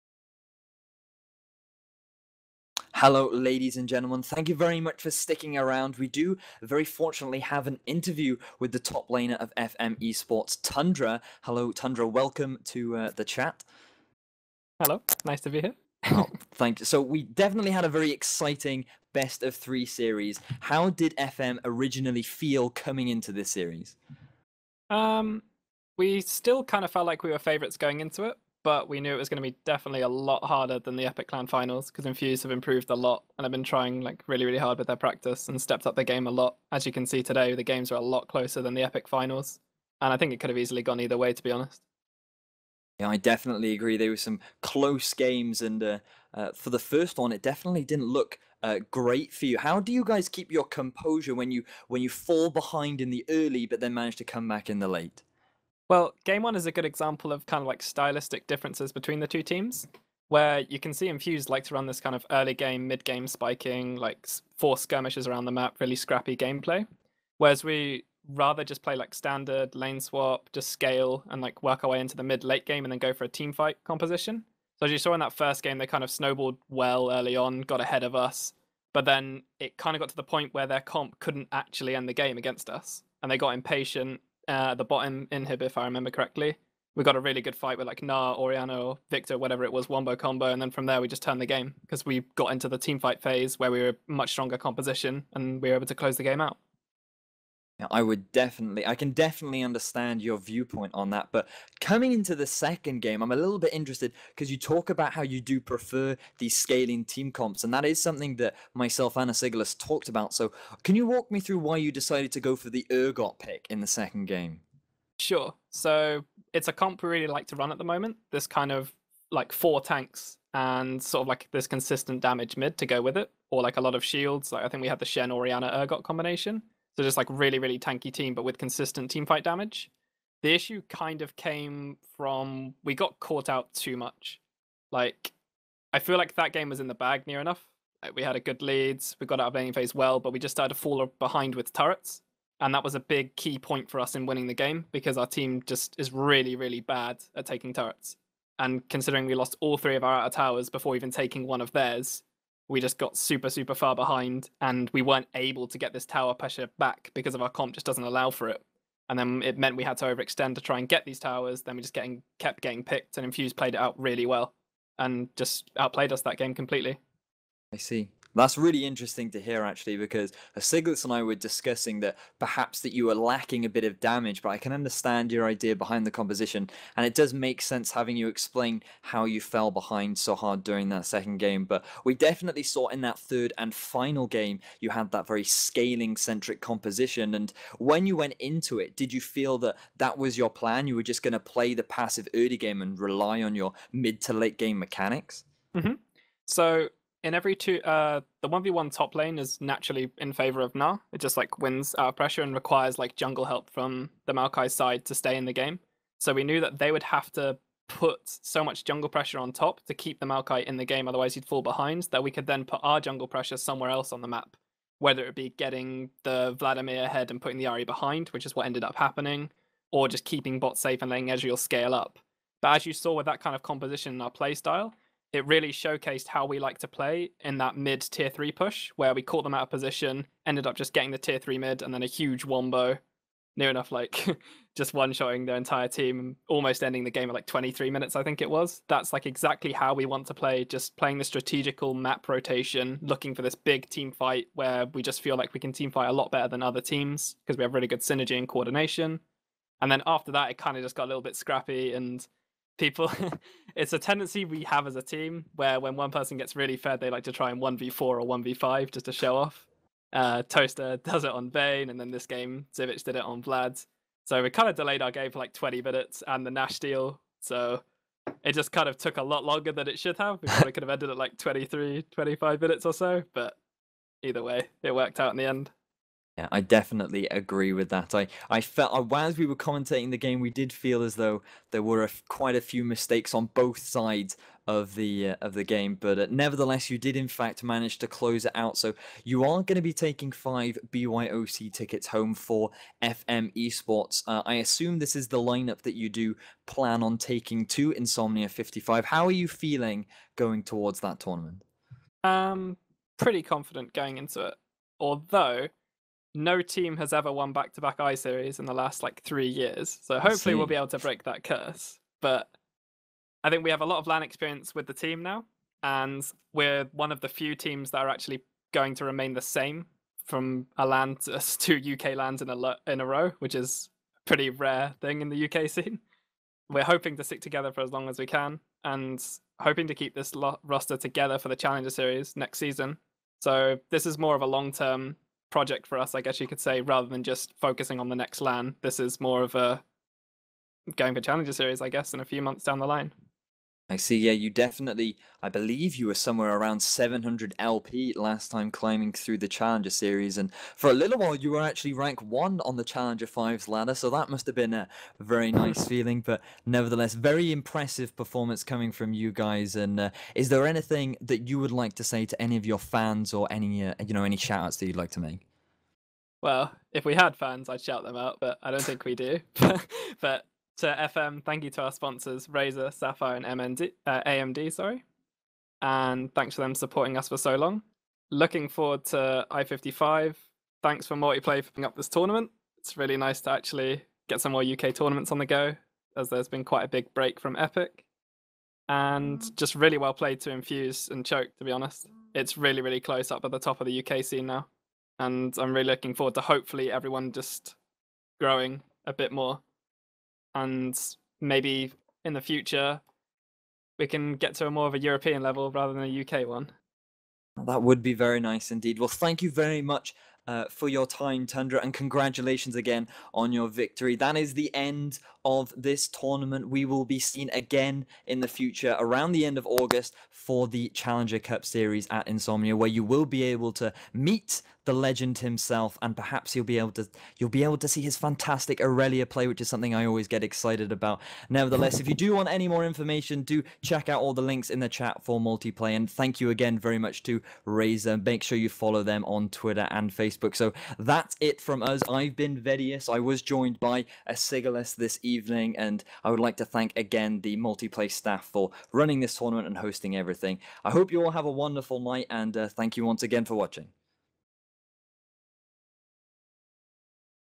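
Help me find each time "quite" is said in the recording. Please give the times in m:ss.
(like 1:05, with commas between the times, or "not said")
4:42, 6:26.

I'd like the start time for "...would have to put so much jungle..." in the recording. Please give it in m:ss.
3:26.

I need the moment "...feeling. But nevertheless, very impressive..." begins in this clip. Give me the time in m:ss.
5:55.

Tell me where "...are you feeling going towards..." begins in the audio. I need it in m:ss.
4:59.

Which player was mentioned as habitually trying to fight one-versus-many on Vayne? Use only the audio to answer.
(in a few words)
Toaster.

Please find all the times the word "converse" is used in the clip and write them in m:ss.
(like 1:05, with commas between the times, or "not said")
not said.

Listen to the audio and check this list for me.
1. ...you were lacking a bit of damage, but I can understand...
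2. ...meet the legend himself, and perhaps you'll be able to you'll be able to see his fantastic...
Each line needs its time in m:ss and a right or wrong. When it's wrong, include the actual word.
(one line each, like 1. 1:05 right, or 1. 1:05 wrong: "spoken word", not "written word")
1. 2:52 right
2. 7:04 right.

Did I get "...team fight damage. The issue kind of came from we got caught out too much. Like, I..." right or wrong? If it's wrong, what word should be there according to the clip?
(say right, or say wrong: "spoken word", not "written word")
right.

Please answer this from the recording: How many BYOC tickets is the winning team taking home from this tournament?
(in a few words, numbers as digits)
5.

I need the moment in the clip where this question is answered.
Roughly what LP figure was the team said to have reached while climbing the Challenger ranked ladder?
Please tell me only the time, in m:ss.
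5:46.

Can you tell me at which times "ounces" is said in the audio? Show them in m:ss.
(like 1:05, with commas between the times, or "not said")
not said.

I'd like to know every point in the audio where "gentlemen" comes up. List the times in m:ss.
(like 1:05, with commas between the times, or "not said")
0:03.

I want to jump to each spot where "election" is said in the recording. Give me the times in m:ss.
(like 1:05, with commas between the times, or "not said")
not said.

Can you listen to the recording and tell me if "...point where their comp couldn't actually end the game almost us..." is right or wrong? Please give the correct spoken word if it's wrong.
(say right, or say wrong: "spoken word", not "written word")
wrong: "against", not "almost".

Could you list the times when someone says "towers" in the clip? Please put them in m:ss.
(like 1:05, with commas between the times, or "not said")
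2:30, 2:36, 2:41.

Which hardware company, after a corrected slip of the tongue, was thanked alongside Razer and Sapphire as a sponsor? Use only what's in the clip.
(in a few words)
AMD.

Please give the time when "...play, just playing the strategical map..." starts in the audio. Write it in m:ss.
4:00.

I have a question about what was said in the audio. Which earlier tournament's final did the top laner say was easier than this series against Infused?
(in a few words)
Epic LAN finals.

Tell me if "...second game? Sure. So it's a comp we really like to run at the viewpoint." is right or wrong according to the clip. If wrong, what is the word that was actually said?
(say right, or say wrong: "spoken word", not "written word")
wrong: "moment", not "viewpoint".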